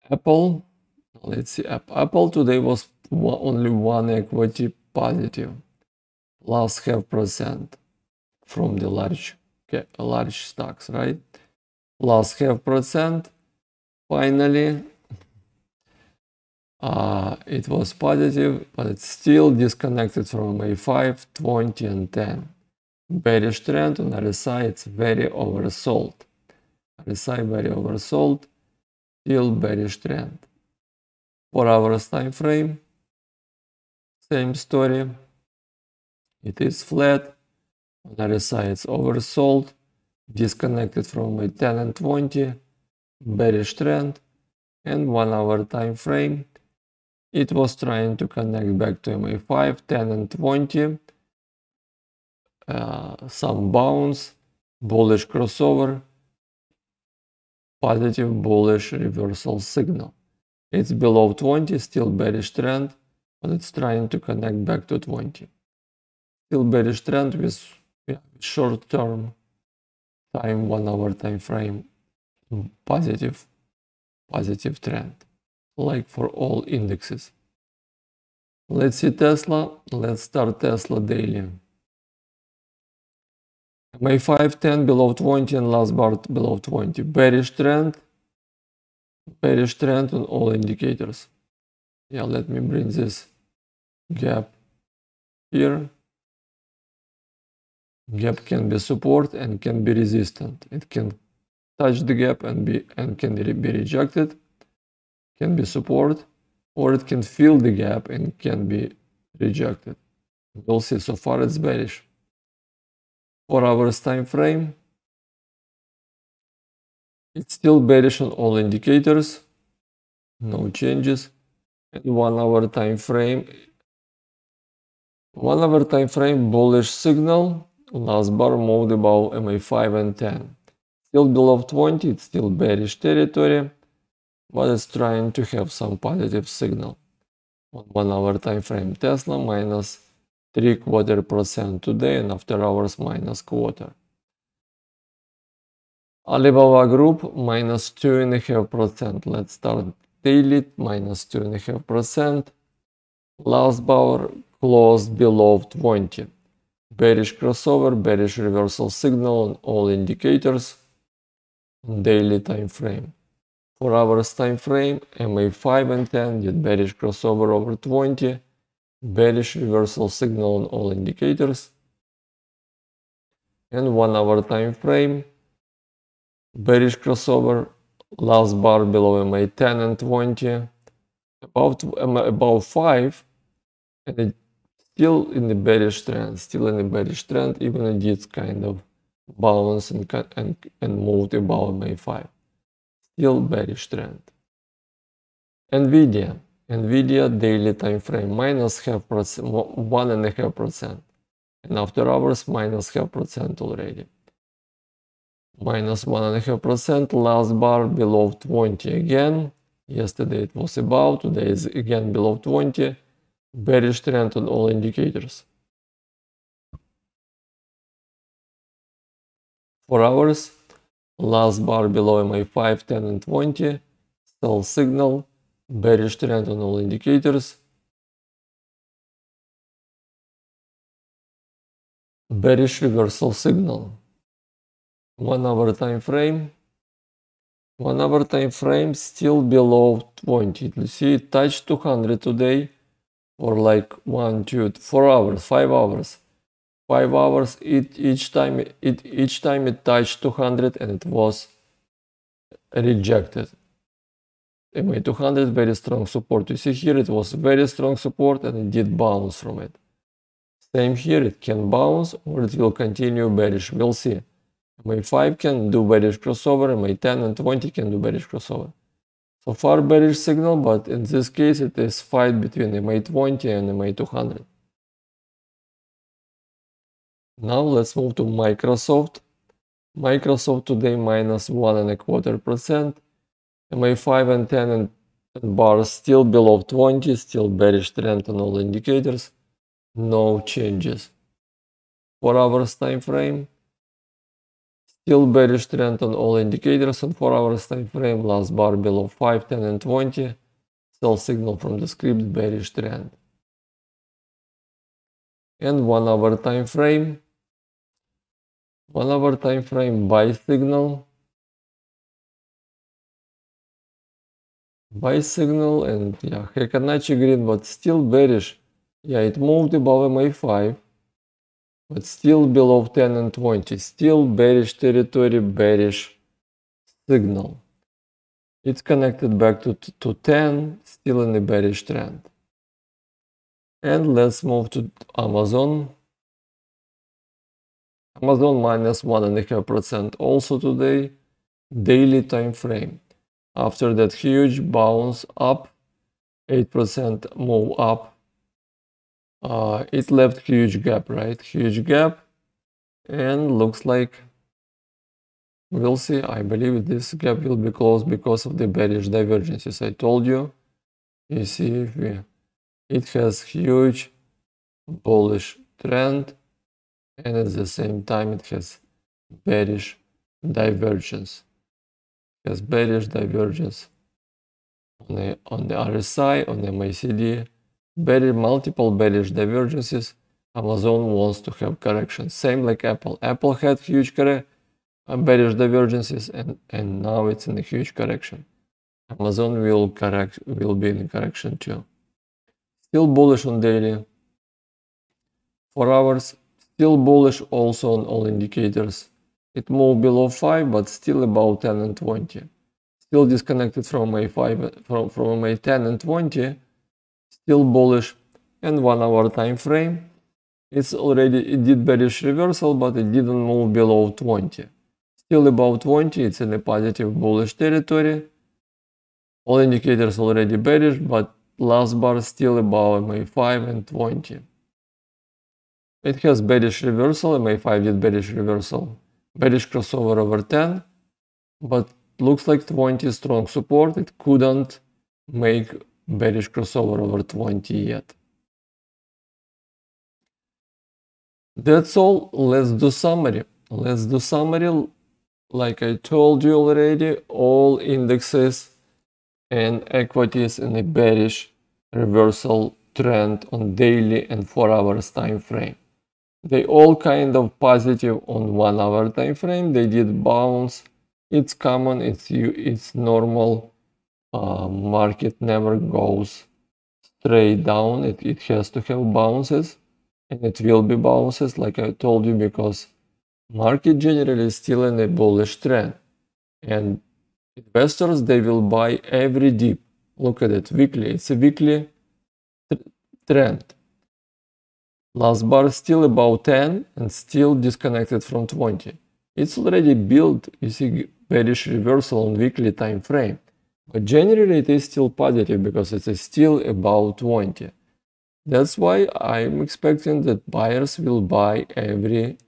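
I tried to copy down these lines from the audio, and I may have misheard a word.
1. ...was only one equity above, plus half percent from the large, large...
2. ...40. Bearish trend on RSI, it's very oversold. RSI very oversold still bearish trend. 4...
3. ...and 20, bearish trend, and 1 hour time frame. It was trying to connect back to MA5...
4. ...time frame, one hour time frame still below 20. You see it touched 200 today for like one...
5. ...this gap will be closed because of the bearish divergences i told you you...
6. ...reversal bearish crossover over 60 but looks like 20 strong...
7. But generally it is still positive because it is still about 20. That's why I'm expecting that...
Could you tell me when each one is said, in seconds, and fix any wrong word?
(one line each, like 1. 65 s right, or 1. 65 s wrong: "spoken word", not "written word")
1. 2 s wrong: "positive", not "above"
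2. 22 s wrong: "10", not "40"
3. 41 s right
4. 235 s right
5. 356 s right
6. 428 s wrong: "10", not "60"
7. 493 s right.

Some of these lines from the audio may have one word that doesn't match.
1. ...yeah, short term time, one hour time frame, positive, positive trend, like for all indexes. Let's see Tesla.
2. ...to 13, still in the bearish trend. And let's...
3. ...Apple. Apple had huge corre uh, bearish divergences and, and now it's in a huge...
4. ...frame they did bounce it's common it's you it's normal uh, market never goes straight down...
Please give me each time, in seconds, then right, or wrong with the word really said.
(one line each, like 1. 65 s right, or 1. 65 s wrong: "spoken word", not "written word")
1. 68 s right
2. 329 s wrong: "10", not "13"
3. 382 s right
4. 459 s right.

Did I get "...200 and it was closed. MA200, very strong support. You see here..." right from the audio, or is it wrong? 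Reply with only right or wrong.
wrong.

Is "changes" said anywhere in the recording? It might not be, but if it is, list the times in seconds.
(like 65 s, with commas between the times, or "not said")
120 s, 290 s.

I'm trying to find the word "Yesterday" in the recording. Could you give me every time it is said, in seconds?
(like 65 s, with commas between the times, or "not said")
209 s.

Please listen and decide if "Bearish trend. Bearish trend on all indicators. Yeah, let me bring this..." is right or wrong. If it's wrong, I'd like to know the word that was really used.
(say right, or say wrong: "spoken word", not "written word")
right.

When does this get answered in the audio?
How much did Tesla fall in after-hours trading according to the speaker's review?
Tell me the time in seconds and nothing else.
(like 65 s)
142 s.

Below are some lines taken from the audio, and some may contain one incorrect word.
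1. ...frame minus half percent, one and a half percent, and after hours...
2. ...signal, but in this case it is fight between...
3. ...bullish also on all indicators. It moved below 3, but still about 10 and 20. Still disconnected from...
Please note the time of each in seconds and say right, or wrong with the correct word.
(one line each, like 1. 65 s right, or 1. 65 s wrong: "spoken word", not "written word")
1. 197 s right
2. 270 s right
3. 396 s wrong: "5", not "3".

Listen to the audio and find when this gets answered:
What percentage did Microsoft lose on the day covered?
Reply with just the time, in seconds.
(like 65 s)
280 s.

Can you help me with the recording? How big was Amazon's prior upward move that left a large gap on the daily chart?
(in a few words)
8%.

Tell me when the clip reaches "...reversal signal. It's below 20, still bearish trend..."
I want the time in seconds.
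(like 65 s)
58 s.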